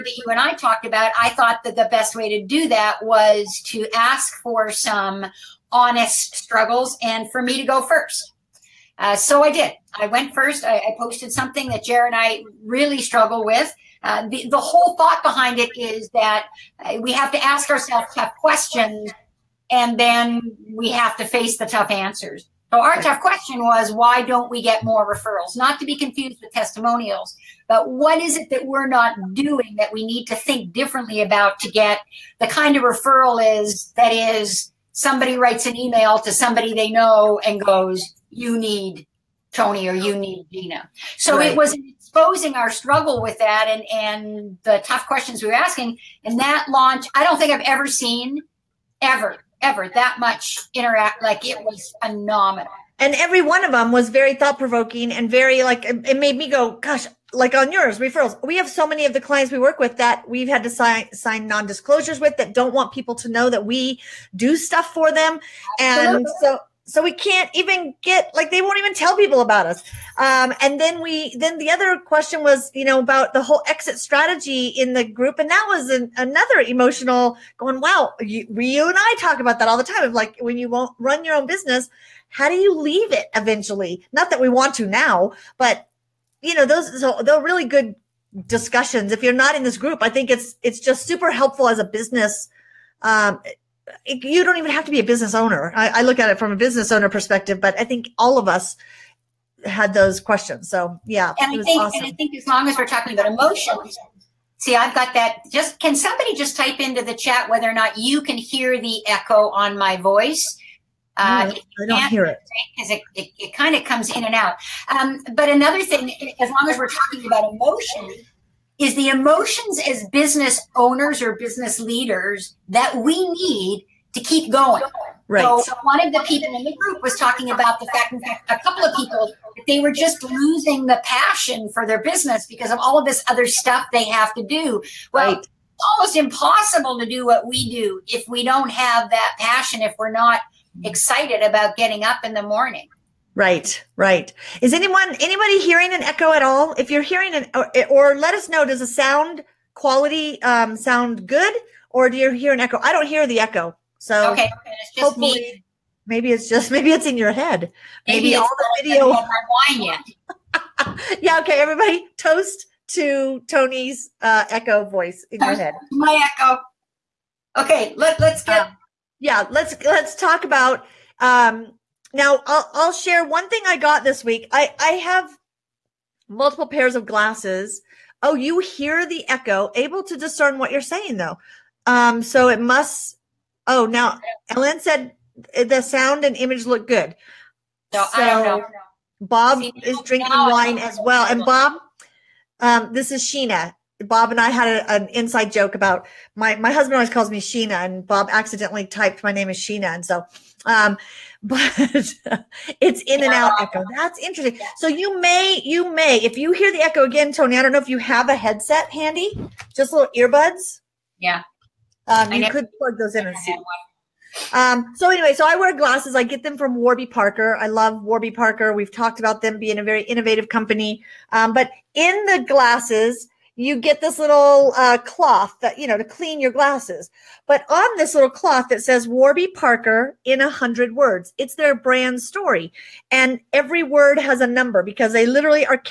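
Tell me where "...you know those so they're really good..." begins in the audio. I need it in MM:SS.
01:26.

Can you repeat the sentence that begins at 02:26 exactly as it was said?
If you're hearing an or, or let us know.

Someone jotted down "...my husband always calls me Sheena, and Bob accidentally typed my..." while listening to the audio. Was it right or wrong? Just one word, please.
right.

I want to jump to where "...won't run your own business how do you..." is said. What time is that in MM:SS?
01:20.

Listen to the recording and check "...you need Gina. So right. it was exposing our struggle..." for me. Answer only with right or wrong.
right.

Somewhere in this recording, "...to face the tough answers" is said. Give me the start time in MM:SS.
00:21.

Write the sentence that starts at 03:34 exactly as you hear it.
Um, so anyway, so I wear glasses.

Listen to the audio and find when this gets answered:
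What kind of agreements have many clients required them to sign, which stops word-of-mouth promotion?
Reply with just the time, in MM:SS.
01:01.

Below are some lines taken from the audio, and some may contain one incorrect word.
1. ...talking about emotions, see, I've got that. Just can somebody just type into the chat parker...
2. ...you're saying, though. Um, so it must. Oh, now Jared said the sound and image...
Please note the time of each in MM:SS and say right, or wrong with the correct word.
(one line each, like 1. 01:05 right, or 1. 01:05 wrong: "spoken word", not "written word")
1. 01:42 wrong: "whether", not "parker"
2. 03:00 wrong: "Ellen", not "Jared".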